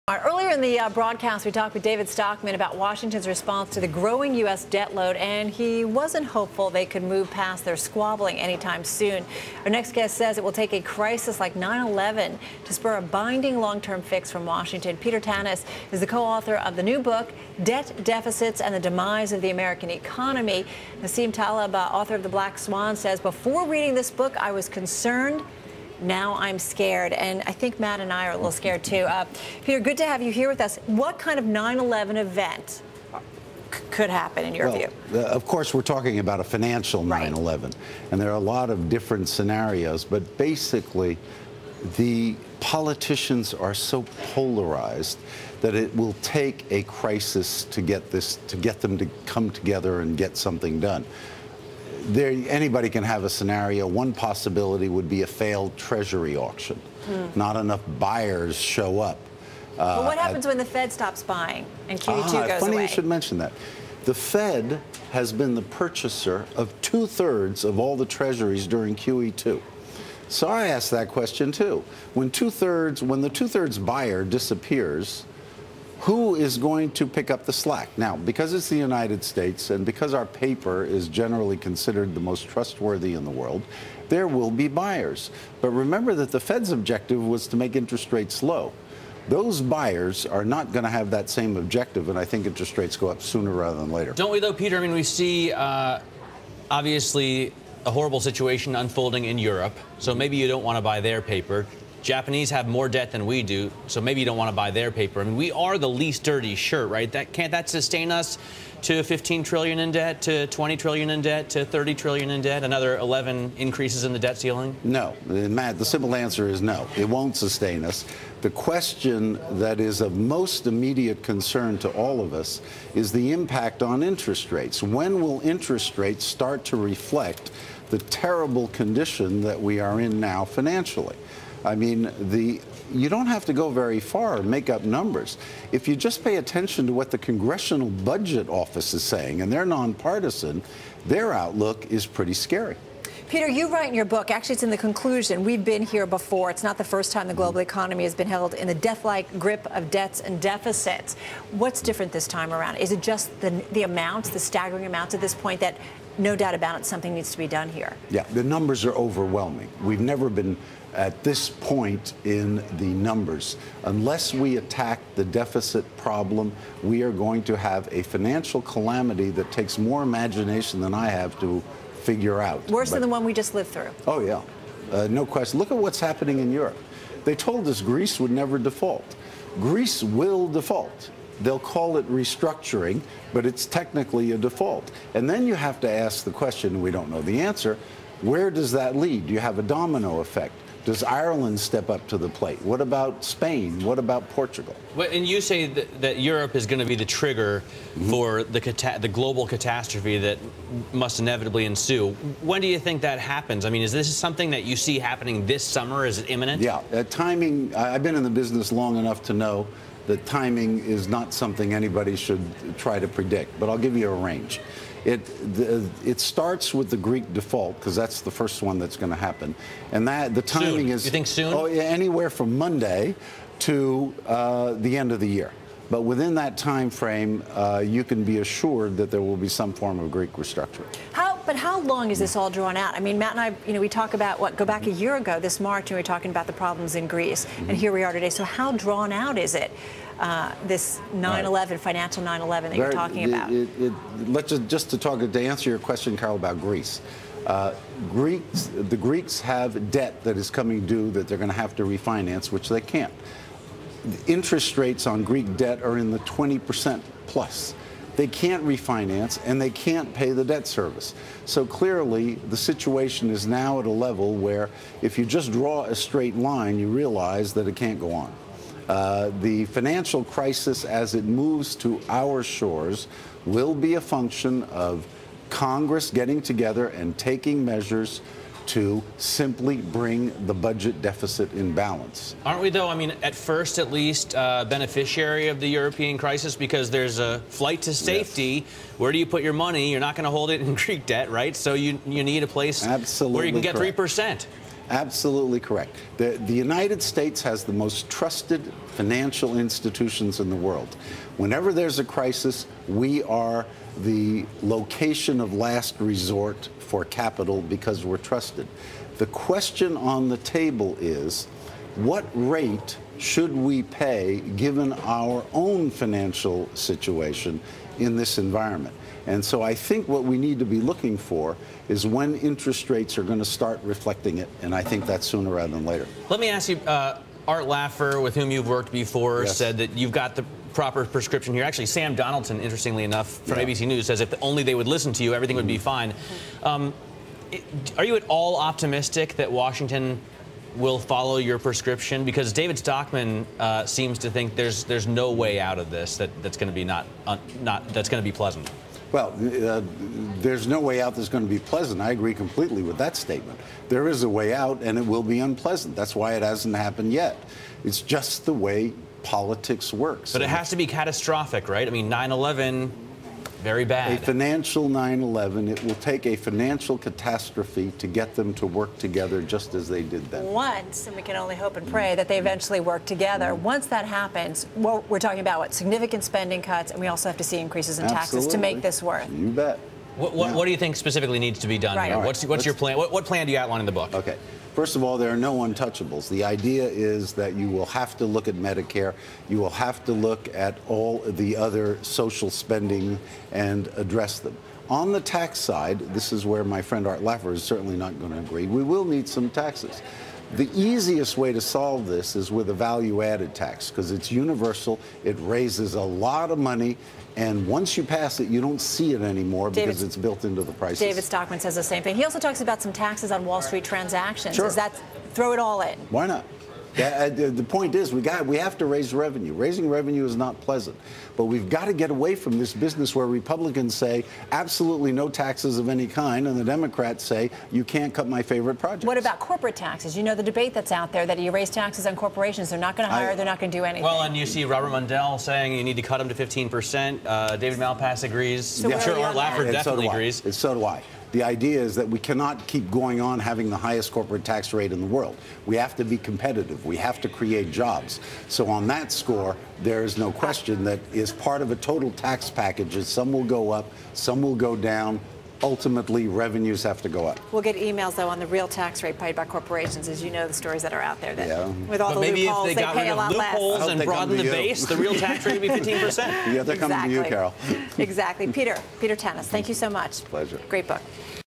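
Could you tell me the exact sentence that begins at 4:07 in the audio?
Uh, Greeks, the Greeks have debt that is coming due that they're going to have to refinance, which they can't.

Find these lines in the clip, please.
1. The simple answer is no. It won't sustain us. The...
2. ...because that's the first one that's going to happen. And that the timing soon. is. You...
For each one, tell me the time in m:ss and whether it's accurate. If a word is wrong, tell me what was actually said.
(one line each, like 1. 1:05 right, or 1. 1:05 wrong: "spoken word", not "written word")
1. 1:55 right
2. 3:37 right.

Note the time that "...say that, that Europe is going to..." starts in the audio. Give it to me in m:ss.
3:15.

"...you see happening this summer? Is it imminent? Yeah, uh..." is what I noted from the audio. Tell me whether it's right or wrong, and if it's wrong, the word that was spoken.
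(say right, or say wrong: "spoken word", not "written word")
right.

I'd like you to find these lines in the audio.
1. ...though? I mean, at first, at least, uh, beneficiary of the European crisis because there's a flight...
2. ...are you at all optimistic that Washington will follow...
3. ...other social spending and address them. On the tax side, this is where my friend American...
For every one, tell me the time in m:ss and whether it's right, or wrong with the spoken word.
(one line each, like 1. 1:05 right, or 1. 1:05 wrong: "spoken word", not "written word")
1. 4:42 right
2. 5:37 right
3. 6:31 wrong: "Art", not "American".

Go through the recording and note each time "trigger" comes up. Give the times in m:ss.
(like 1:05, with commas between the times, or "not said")
3:17.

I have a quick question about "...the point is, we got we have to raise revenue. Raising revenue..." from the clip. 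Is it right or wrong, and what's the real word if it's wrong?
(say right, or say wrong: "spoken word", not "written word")
right.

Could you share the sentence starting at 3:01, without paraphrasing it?
They'll call it restructuring, but it's technically a default.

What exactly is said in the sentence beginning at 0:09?
Our next guest says it will take a crisis like 9 11 to spur a binding long term fix from Washington.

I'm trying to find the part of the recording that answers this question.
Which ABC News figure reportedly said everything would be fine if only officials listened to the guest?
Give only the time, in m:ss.
5:31.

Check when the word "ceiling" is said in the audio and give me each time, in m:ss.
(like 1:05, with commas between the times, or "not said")
1:54.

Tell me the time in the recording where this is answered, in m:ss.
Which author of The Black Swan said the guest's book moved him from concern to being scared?
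0:21.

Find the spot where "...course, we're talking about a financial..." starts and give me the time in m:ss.
0:35.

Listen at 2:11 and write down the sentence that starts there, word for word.
I mean, the you don't have to go very far make up numbers.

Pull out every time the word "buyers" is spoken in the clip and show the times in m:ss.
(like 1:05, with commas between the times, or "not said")
0:57, 1:13, 1:24, 1:29.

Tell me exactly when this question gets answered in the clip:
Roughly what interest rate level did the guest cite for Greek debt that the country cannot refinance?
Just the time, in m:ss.
4:16.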